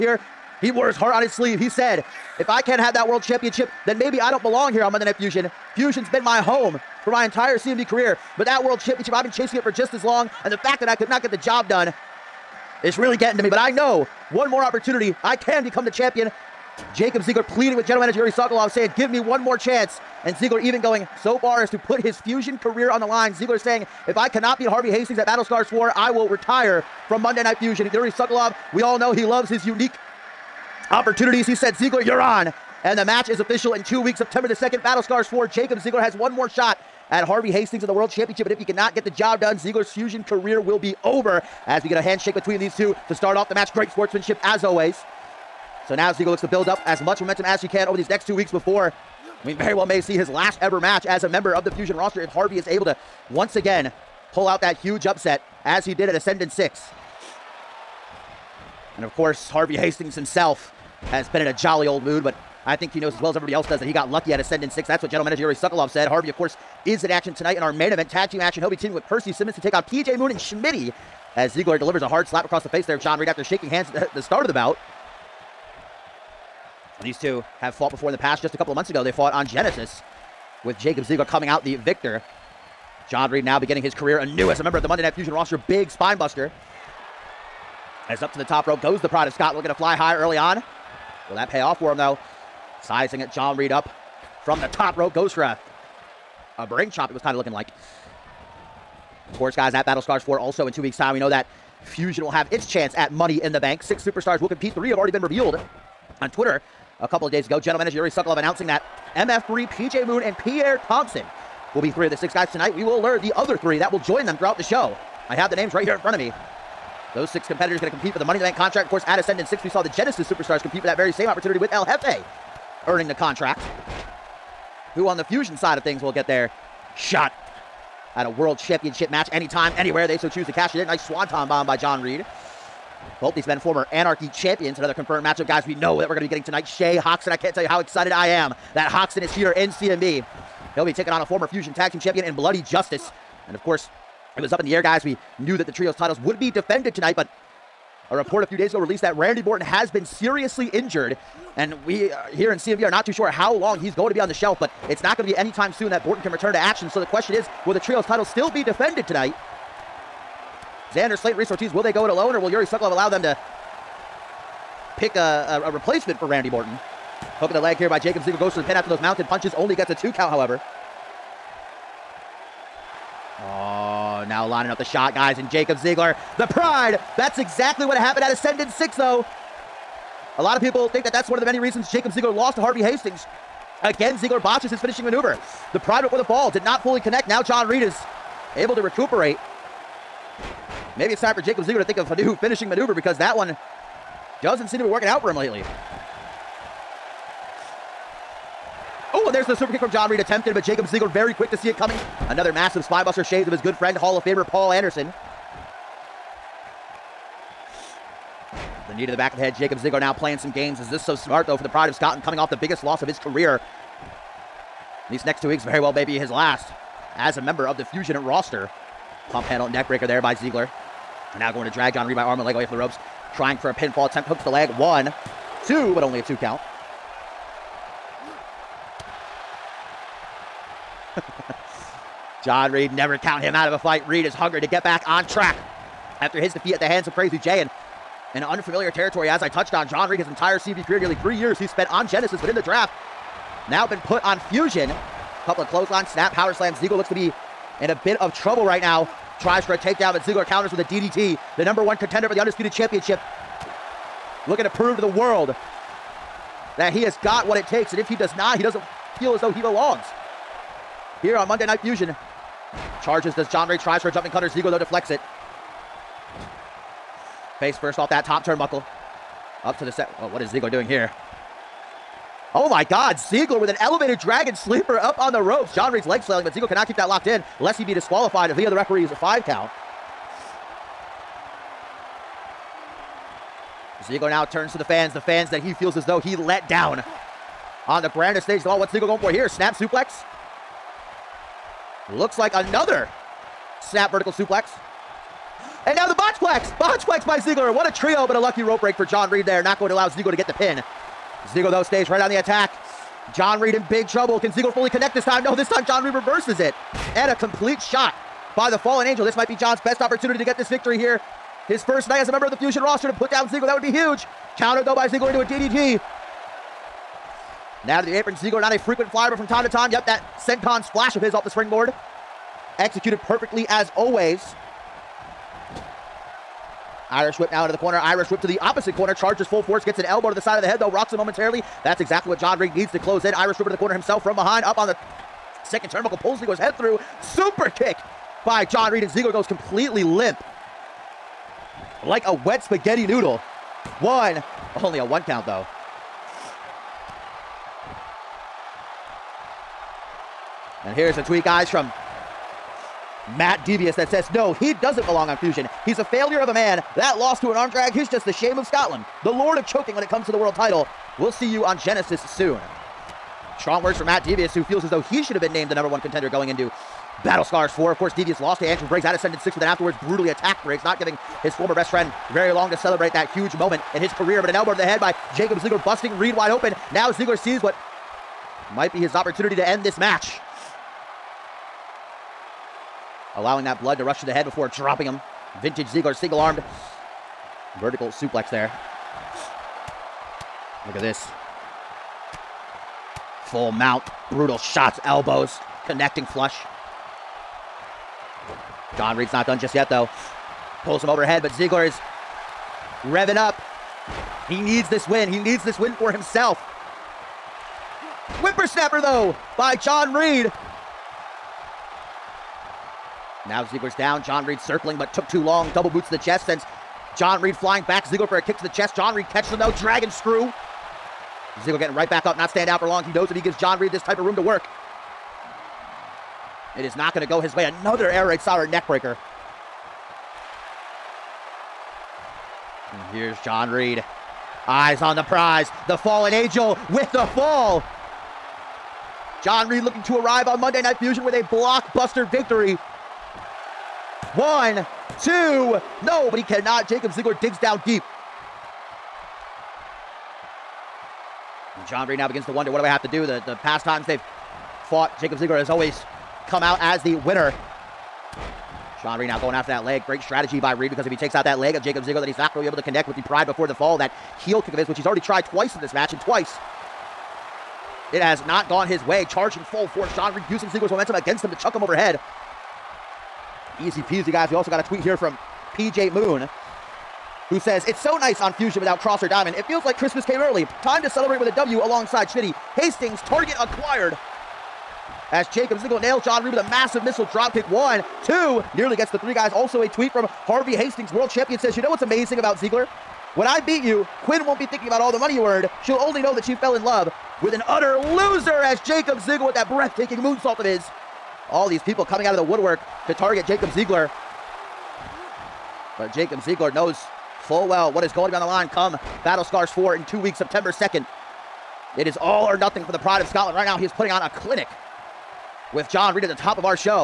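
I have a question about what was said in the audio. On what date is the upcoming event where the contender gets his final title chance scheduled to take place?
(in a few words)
September 2nd.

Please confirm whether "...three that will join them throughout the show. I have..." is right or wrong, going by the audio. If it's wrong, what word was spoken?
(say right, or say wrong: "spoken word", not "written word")
right.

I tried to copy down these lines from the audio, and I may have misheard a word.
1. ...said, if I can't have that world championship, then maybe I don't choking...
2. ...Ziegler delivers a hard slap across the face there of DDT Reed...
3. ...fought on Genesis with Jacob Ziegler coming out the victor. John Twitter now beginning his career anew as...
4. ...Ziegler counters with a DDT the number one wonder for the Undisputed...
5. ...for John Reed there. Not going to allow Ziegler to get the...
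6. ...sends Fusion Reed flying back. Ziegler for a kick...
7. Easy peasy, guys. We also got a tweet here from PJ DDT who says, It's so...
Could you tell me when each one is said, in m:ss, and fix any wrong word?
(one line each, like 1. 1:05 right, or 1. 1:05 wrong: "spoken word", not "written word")
1. 0:01 wrong: "belong", not "choking"
2. 1:11 wrong: "John", not "DDT"
3. 1:19 wrong: "Reed", not "Twitter"
4. 4:10 wrong: "contender", not "wonder"
5. 4:58 right
6. 6:56 wrong: "John", not "Fusion"
7. 7:53 wrong: "Moon", not "DDT".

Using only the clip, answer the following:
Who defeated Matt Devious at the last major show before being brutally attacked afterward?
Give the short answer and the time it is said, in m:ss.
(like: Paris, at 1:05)
Andrew Briggs, at 6:08.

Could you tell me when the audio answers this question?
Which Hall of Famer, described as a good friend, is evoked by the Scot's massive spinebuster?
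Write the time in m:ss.
3:24.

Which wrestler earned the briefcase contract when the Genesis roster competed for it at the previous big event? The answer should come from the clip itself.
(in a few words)
El Jefe.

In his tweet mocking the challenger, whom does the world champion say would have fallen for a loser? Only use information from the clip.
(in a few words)
Quinn.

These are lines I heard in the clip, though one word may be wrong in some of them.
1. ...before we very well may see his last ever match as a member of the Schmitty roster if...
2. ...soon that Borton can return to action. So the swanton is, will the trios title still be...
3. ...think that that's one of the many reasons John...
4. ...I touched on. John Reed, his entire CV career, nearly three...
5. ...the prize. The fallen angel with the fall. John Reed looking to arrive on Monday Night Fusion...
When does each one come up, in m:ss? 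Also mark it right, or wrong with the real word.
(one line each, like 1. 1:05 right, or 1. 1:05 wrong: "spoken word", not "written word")
1. 0:48 wrong: "Fusion", not "Schmitty"
2. 2:35 wrong: "question", not "swanton"
3. 3:00 wrong: "Jacob", not "John"
4. 3:59 right
5. 7:15 right.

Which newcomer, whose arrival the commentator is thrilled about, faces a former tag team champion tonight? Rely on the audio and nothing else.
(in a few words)
Shay Hoxton.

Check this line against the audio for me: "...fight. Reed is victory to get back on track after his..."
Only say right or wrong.
wrong.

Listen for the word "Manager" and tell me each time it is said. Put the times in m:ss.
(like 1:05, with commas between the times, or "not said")
0:18, 1:05, 1:47.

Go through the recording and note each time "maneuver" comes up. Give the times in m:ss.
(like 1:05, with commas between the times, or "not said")
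3:05, 3:12.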